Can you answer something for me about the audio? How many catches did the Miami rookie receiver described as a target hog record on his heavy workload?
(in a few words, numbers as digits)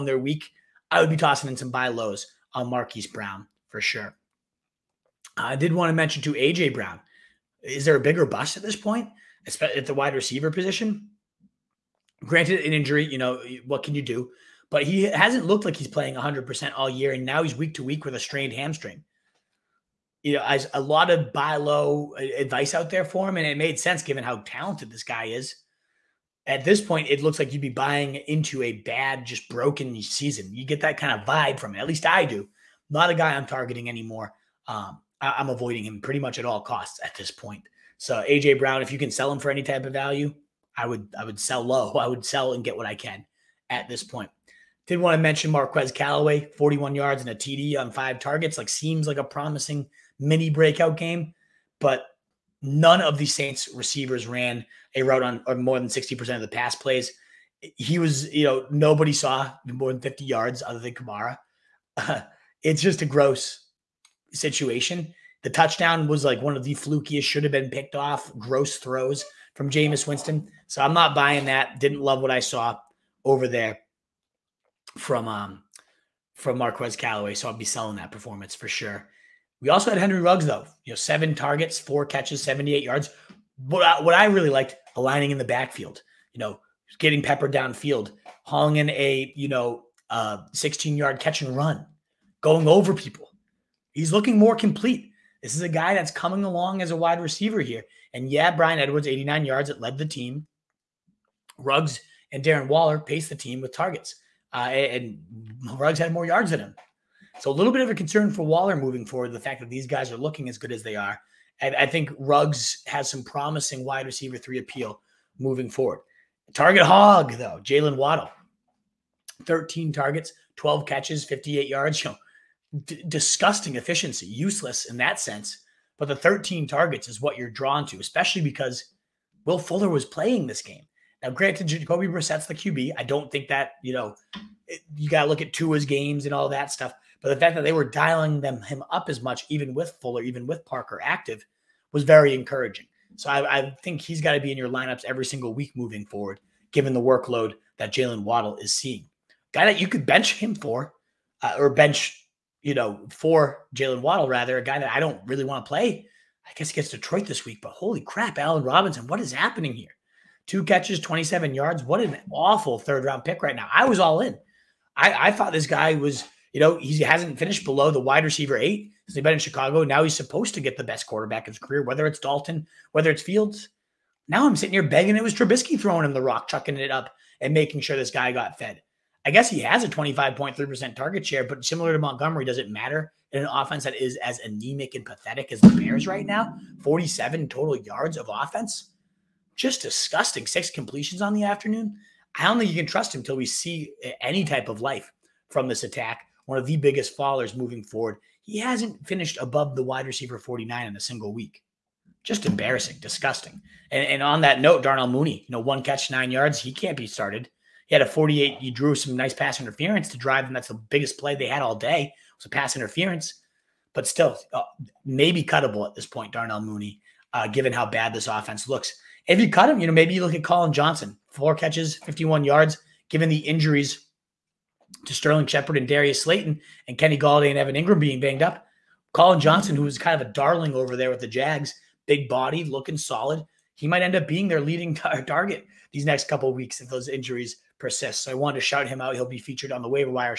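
12.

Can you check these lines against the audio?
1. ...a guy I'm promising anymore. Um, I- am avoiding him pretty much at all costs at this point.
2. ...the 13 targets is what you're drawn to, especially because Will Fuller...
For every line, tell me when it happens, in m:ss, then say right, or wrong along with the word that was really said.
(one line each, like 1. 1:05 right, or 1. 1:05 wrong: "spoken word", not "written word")
1. 0:33 wrong: "targeting", not "promising"
2. 2:06 right.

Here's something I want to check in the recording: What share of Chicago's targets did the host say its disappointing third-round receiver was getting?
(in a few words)
25.3%.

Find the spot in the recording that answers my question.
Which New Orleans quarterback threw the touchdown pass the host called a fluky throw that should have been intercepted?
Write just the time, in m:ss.
1:09.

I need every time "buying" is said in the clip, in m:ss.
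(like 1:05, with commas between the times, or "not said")
0:27, 1:11.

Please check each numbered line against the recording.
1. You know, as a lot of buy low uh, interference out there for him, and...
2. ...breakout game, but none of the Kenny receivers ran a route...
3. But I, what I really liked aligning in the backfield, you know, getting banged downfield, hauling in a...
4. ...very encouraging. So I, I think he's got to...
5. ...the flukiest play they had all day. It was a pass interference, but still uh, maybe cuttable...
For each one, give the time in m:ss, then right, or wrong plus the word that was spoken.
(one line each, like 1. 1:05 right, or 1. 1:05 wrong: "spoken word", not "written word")
1. 0:20 wrong: "advice", not "interference"
2. 0:50 wrong: "Saints", not "Kenny"
3. 1:23 wrong: "peppered", not "banged"
4. 2:22 right
5. 3:30 wrong: "biggest", not "flukiest".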